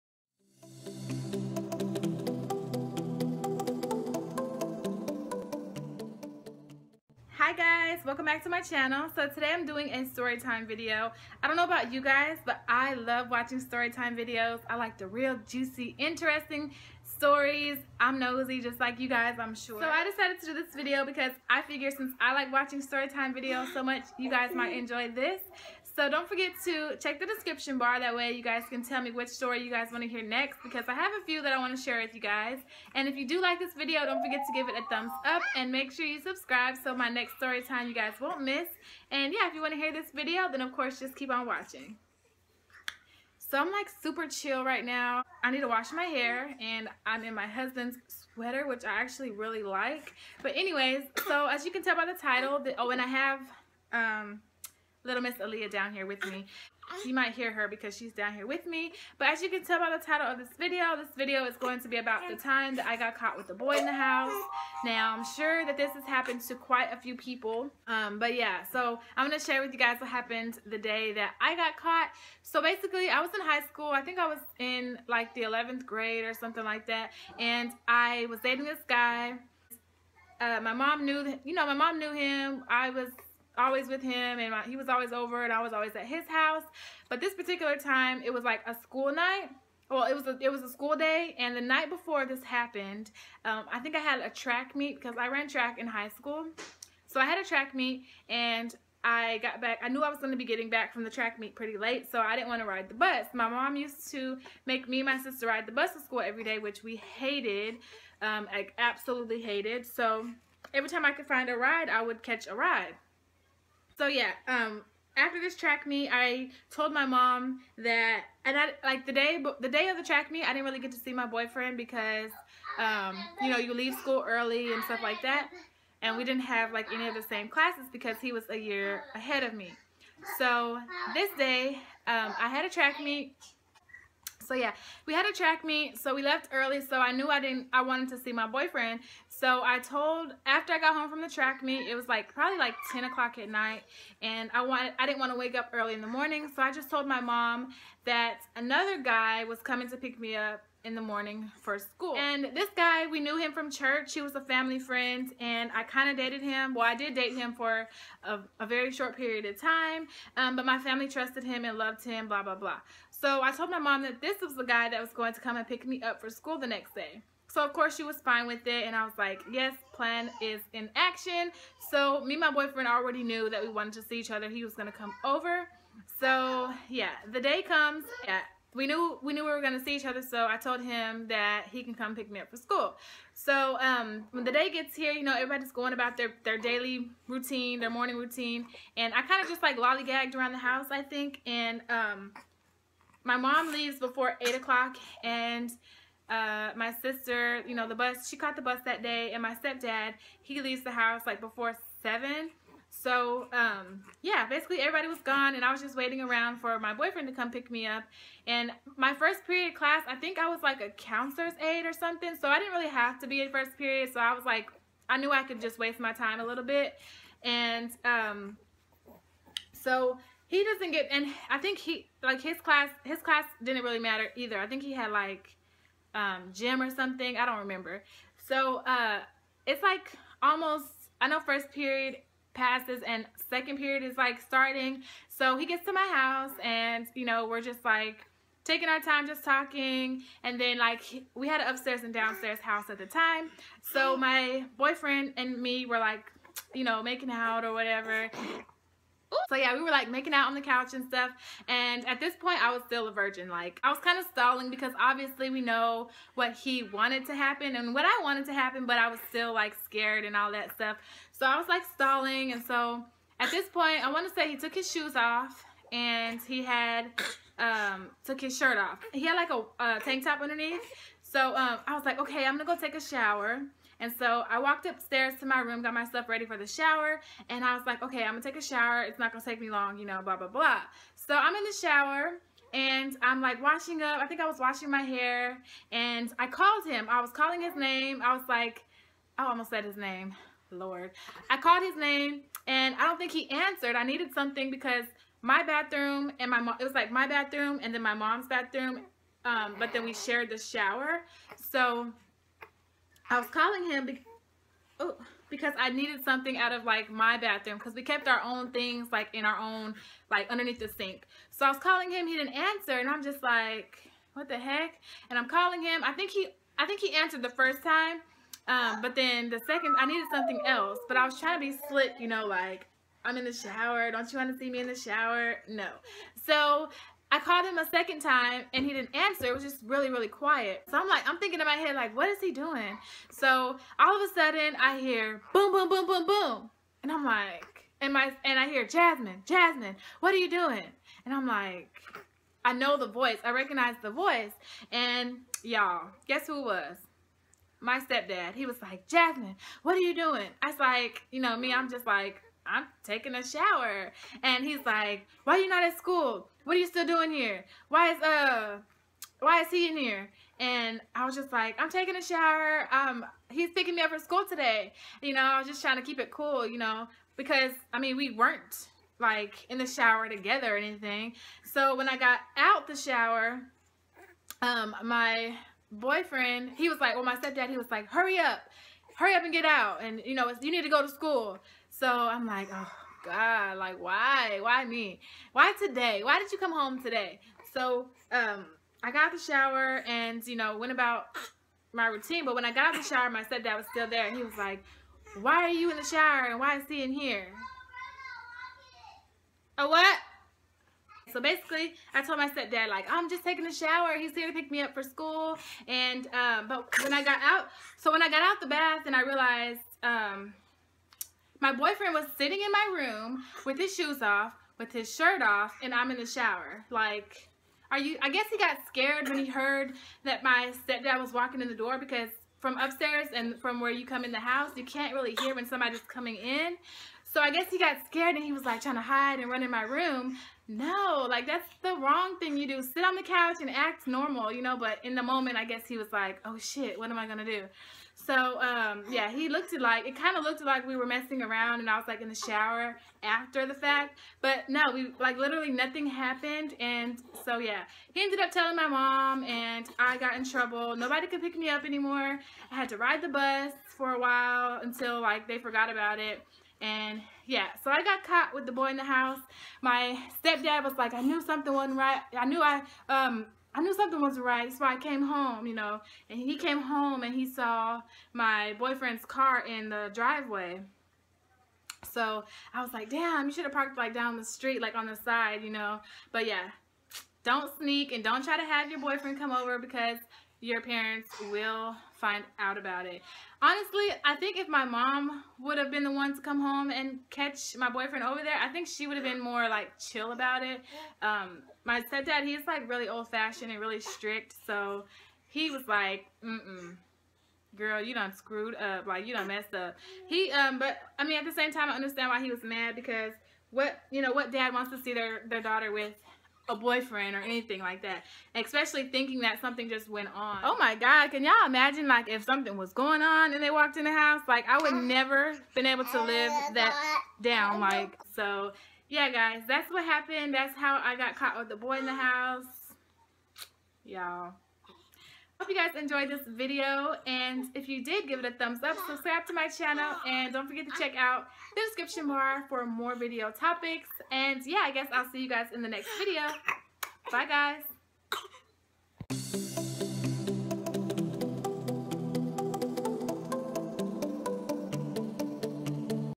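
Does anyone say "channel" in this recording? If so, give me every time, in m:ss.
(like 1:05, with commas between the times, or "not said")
0:08, 8:49.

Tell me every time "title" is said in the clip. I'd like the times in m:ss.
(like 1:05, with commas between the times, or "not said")
0:52, 1:00.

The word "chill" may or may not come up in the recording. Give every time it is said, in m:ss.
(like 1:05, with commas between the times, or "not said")
0:44, 8:09.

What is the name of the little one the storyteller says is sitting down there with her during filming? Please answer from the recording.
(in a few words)
Aaliyah.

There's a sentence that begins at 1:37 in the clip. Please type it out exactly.
So I had a track meet, and I got back.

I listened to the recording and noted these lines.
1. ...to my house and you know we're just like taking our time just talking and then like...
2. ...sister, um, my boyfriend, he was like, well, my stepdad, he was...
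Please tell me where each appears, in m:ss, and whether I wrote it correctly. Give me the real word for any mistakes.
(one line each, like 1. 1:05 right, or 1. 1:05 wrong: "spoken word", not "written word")
1. 3:55 right
2. 6:12 wrong: "shower", not "sister".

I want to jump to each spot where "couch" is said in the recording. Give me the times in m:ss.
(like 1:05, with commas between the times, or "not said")
4:10, 7:13.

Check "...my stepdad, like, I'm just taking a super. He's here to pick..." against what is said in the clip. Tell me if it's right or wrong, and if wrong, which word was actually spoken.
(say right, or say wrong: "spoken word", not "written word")
wrong: "shower", not "super".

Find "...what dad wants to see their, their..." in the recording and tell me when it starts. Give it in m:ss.
8:24.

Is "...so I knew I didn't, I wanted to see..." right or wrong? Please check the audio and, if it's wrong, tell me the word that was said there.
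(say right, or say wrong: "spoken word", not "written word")
right.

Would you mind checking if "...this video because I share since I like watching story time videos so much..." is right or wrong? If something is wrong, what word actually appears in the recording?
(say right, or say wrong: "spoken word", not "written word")
wrong: "figure", not "share".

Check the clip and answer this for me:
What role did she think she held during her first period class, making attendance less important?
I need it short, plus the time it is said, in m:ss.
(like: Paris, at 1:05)
Counselor's aide, at 3:30.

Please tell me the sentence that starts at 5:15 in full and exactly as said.
And I'm calling him, I think he, I think he answered the first time.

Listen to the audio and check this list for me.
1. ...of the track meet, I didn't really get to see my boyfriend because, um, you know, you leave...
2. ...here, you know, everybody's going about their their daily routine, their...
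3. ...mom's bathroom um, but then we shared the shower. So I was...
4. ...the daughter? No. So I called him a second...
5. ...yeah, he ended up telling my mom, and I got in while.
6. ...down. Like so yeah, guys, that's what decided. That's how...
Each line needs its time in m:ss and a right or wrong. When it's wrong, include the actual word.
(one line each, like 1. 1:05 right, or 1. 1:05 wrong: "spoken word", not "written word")
1. 1:59 right
2. 3:04 right
3. 4:58 right
4. 5:24 wrong: "shower", not "daughter"
5. 7:27 wrong: "trouble", not "while"
6. 8:37 wrong: "happened", not "decided".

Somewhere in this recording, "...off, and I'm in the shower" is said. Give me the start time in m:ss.
6:55.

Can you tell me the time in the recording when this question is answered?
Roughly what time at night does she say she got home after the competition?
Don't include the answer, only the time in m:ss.
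2:22.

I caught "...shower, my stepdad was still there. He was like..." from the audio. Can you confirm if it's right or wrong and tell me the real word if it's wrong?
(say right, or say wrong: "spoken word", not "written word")
right.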